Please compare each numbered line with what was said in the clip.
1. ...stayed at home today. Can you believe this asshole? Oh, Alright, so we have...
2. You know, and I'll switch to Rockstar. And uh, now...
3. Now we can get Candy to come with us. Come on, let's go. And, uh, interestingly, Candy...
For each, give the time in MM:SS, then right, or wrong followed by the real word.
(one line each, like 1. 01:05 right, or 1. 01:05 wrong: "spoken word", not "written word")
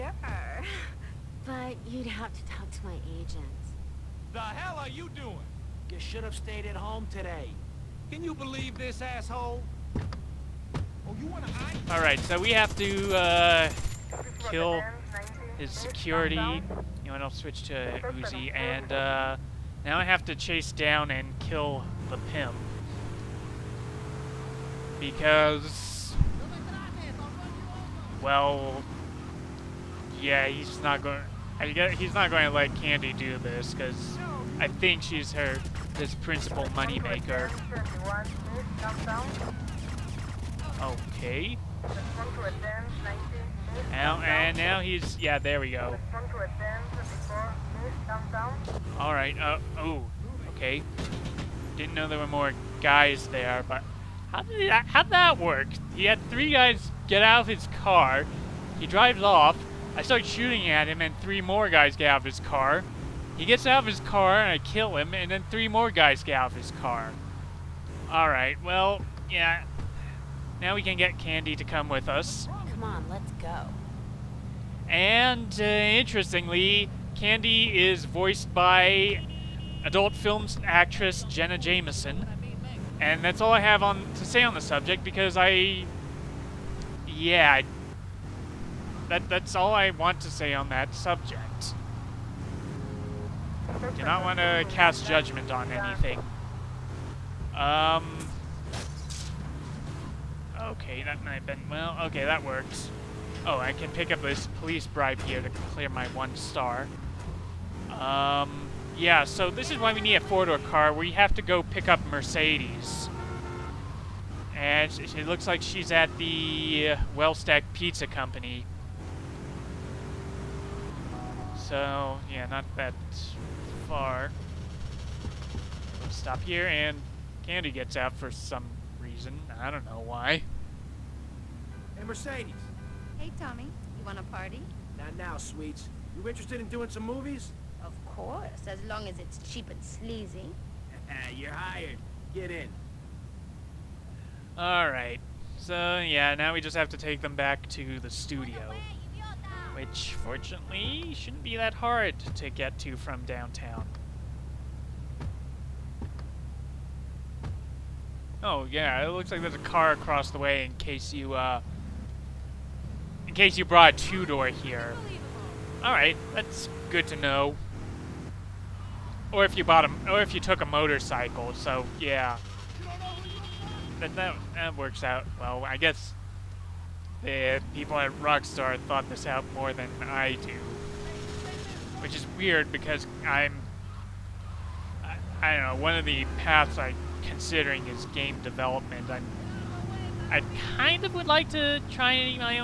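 1. 00:06 right
2. 00:16 wrong: "Uzi", not "Rockstar"
3. 01:10 right.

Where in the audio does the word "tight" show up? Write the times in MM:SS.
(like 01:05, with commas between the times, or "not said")
not said.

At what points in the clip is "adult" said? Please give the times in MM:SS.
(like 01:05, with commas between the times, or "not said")
01:19.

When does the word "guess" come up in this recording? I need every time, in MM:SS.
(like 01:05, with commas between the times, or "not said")
00:31, 02:55.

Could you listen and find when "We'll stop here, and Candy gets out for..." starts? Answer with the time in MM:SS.
02:06.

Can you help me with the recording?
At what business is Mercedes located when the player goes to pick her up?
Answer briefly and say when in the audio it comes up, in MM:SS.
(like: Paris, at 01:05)
Well Stacked Pizza Company, at 01:57.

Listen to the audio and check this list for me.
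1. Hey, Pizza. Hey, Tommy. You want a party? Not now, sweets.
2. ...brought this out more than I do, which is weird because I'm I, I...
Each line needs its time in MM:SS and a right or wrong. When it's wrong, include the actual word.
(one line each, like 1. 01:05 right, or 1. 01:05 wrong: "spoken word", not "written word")
1. 02:11 wrong: "Mercedes", not "Pizza"
2. 02:58 wrong: "thought", not "brought".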